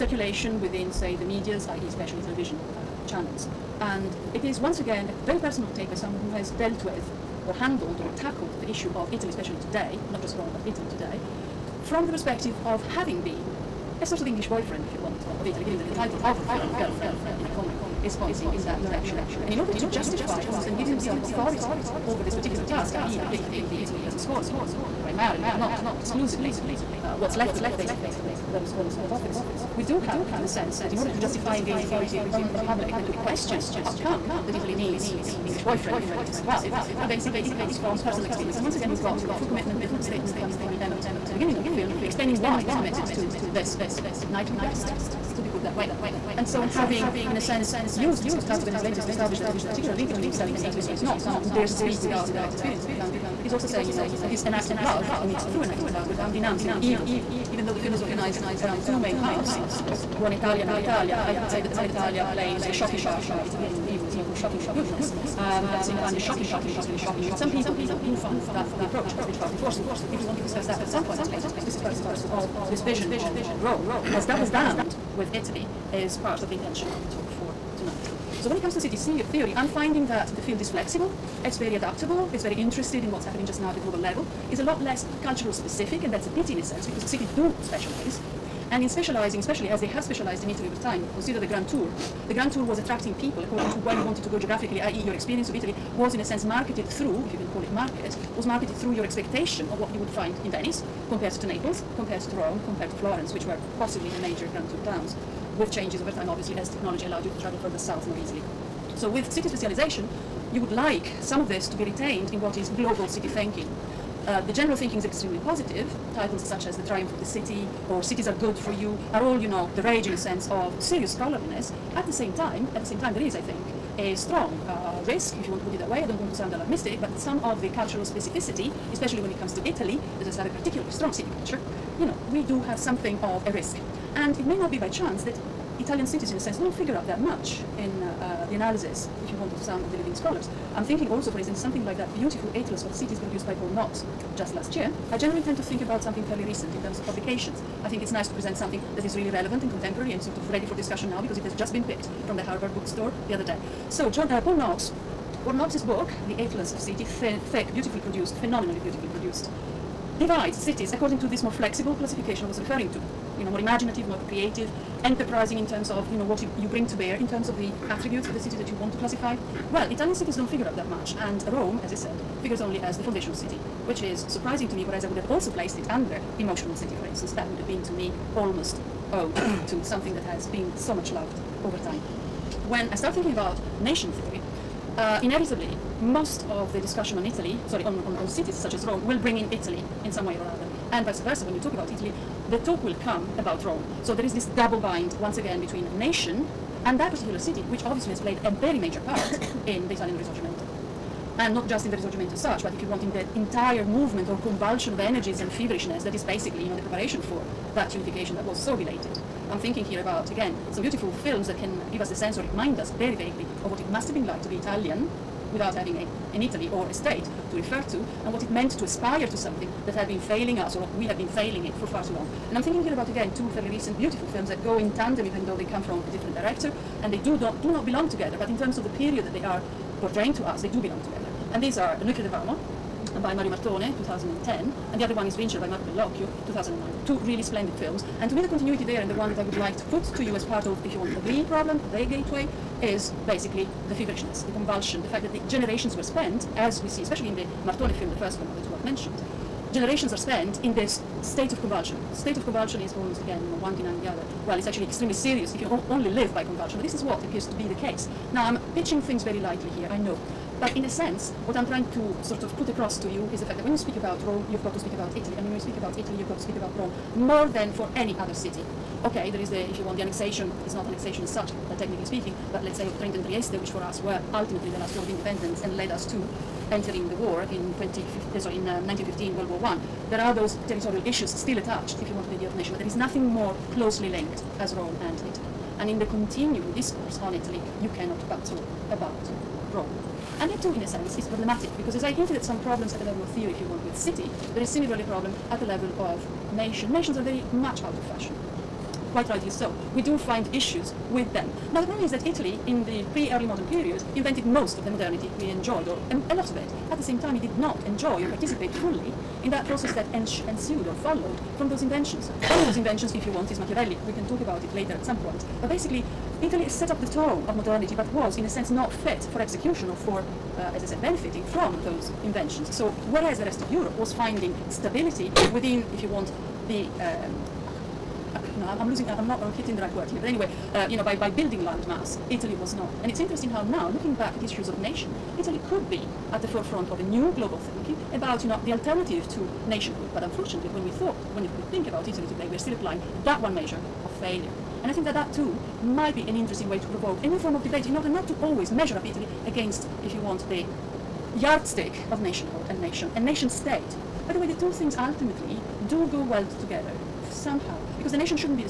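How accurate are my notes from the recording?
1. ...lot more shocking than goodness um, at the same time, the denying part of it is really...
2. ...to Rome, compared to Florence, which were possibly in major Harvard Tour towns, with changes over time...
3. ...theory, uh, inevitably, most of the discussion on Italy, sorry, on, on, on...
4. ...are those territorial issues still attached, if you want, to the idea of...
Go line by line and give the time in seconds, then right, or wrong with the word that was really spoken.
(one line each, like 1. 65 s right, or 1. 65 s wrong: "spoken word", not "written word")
1. 64 s wrong: "shocking", not "denying"
2. 102 s wrong: "Grand", not "Harvard"
3. 184 s right
4. 280 s right.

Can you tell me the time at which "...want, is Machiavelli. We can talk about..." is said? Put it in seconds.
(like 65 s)
313 s.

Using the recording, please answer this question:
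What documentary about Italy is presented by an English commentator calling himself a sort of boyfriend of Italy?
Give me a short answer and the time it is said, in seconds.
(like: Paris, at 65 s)
Girlfriend in a Coma, at 16 s.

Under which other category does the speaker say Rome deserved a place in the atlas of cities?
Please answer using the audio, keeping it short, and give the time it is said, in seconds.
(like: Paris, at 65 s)
emotional city, at 176 s.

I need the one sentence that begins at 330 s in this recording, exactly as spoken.
But anyway, uh, you know, by, by building land mass, Italy was not.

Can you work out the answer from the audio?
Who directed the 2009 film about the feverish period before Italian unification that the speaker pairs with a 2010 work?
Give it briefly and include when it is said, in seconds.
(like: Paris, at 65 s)
Marco Bellocchio, at 235 s.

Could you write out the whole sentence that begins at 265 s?
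And when you speak about Italy, you've got to speak about Rome more than for any other city.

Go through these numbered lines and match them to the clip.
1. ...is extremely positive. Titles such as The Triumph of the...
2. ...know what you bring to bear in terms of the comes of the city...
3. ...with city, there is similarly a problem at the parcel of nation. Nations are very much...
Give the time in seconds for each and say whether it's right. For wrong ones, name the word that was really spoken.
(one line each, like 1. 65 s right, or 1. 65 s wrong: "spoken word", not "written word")
1. 114 s right
2. 166 s wrong: "attributes", not "comes"
3. 293 s wrong: "level", not "parcel".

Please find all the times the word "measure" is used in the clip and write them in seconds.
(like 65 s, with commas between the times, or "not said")
343 s, 348 s.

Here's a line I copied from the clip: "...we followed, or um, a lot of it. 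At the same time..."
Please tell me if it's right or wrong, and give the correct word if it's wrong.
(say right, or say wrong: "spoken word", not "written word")
wrong: "enjoyed", not "followed".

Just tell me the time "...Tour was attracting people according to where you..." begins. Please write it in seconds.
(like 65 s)
92 s.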